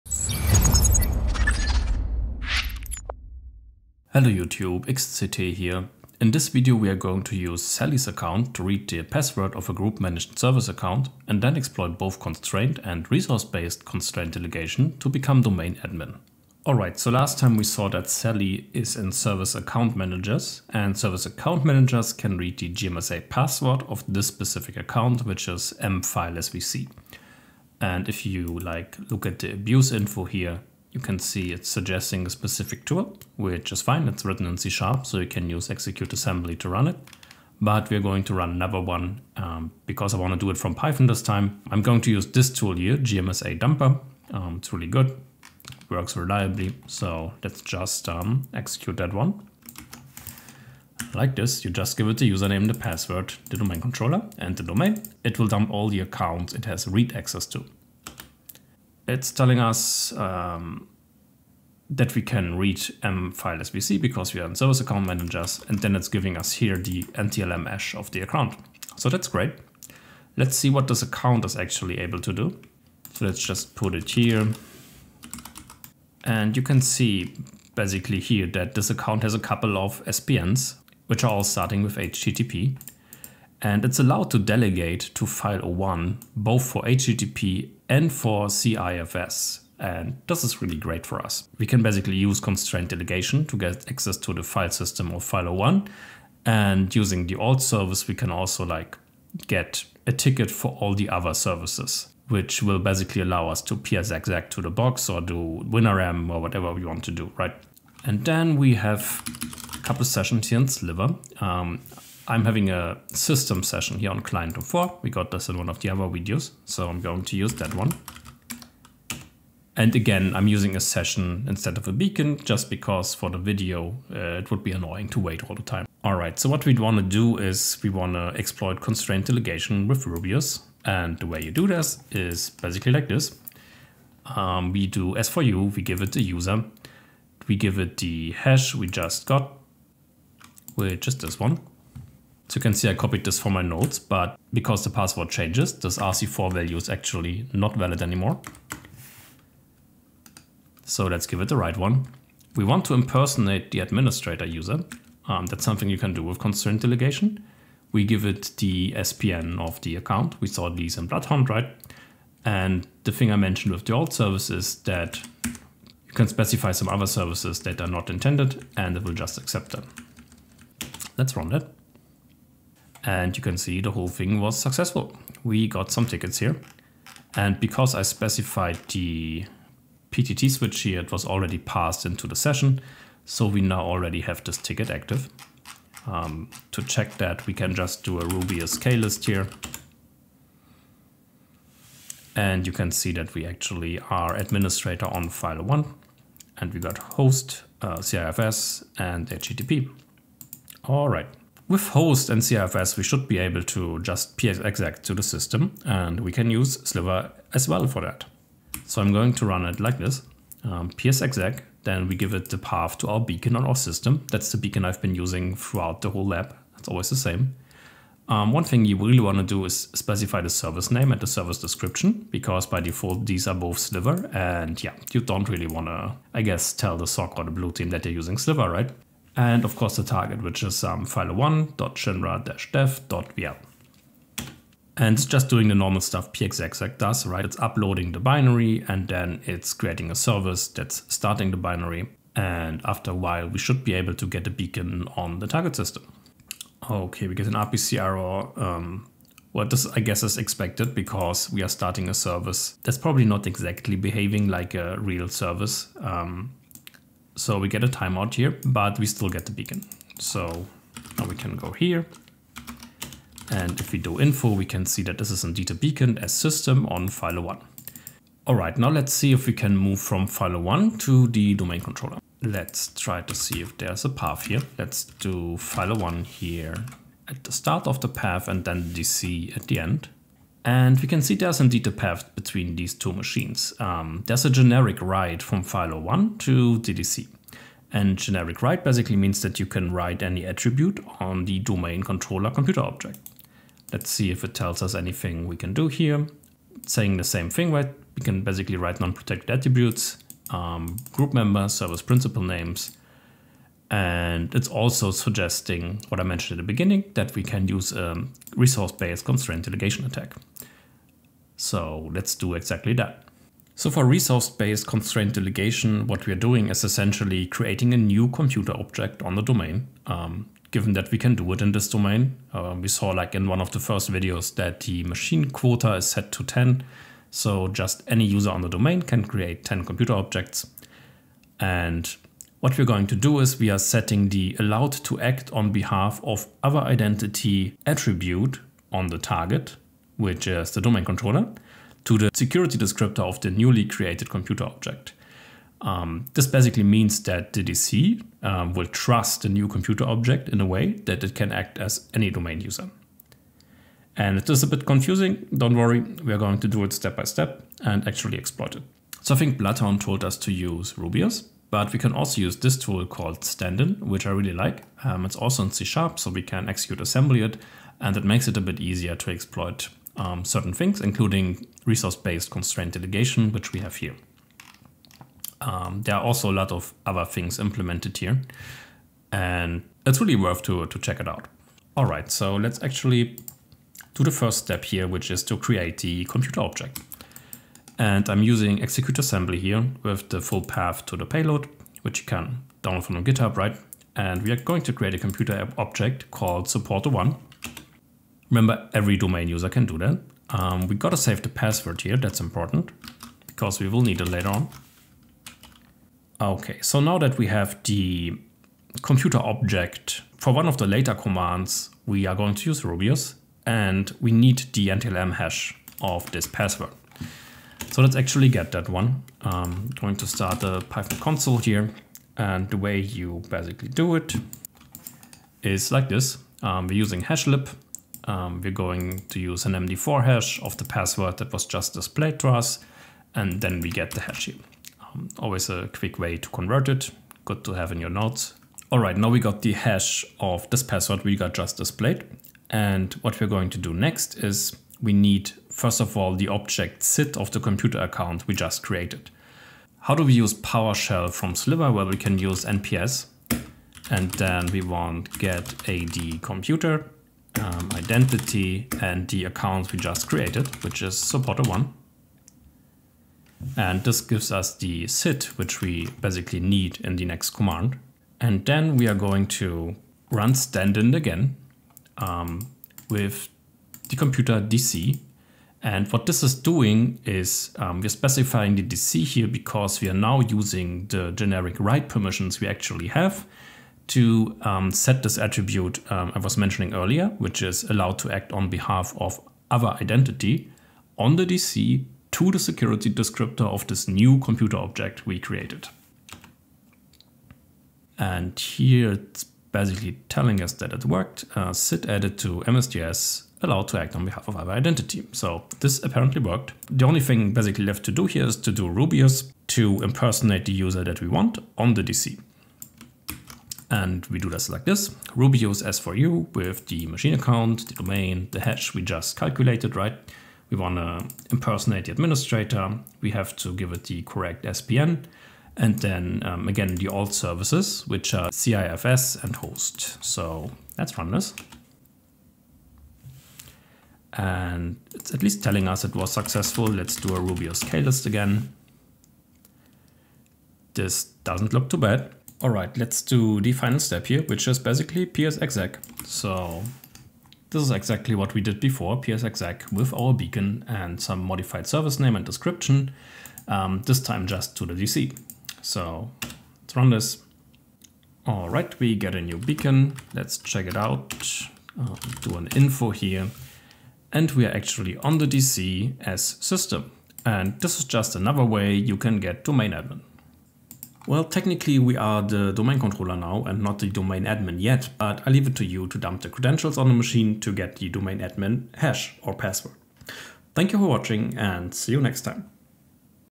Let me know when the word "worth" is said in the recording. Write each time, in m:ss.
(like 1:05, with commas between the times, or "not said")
6:20.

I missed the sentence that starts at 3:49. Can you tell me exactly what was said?
and of course the target, which is um, file1.shinra-dev.vl.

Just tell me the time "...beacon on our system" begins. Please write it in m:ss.
3:33.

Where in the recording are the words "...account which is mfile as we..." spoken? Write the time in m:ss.
0:24.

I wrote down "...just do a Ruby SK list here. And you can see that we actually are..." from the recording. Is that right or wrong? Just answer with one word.
right.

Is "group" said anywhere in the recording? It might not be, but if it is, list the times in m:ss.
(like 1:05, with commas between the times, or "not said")
0:09, 5:01.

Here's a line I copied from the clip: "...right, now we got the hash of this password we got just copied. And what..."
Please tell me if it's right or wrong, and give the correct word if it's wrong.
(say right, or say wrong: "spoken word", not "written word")
wrong: "displayed", not "copied".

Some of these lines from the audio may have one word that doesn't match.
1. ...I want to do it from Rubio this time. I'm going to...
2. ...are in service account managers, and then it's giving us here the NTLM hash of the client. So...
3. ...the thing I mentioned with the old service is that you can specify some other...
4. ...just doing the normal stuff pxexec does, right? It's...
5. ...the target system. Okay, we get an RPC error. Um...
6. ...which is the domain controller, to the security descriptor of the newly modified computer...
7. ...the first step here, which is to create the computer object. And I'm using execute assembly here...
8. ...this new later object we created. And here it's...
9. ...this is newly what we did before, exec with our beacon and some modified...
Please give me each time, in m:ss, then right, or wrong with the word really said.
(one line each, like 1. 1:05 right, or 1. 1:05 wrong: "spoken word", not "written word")
1. 0:40 wrong: "Python", not "Rubio"
2. 1:04 wrong: "account", not "client"
3. 2:43 right
4. 3:55 right
5. 4:05 right
6. 5:40 wrong: "created", not "modified"
7. 6:24 right
8. 8:13 wrong: "computer", not "later"
9. 9:07 wrong: "exactly", not "newly".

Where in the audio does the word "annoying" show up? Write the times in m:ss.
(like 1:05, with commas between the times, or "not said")
2:04.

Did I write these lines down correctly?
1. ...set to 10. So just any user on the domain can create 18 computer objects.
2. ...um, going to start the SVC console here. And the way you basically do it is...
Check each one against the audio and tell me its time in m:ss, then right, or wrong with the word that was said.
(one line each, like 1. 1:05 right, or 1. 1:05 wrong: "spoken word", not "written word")
1. 5:26 wrong: "10", not "18"
2. 6:59 wrong: "Python", not "SVC".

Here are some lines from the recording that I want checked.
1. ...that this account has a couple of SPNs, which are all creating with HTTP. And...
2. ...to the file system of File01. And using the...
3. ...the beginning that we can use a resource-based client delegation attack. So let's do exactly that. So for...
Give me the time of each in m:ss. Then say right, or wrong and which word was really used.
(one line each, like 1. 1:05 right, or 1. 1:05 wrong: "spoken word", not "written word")
1. 1:18 wrong: "starting", not "creating"
2. 1:34 right
3. 5:06 wrong: "constraint", not "client".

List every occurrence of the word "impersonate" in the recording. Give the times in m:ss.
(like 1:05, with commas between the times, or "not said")
2:32, 8:30, 8:41.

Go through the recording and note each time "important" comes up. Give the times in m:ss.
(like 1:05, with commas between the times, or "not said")
6:42.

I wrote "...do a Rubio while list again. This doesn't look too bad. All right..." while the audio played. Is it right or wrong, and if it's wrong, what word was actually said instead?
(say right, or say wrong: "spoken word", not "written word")
wrong: "scale", not "while".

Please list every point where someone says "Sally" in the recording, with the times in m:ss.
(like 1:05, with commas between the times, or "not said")
0:07, 0:18.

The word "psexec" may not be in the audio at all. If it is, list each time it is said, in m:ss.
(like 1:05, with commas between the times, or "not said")
3:24, 3:30.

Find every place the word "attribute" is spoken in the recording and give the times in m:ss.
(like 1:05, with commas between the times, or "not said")
4:50, 4:59, 5:37, 8:05.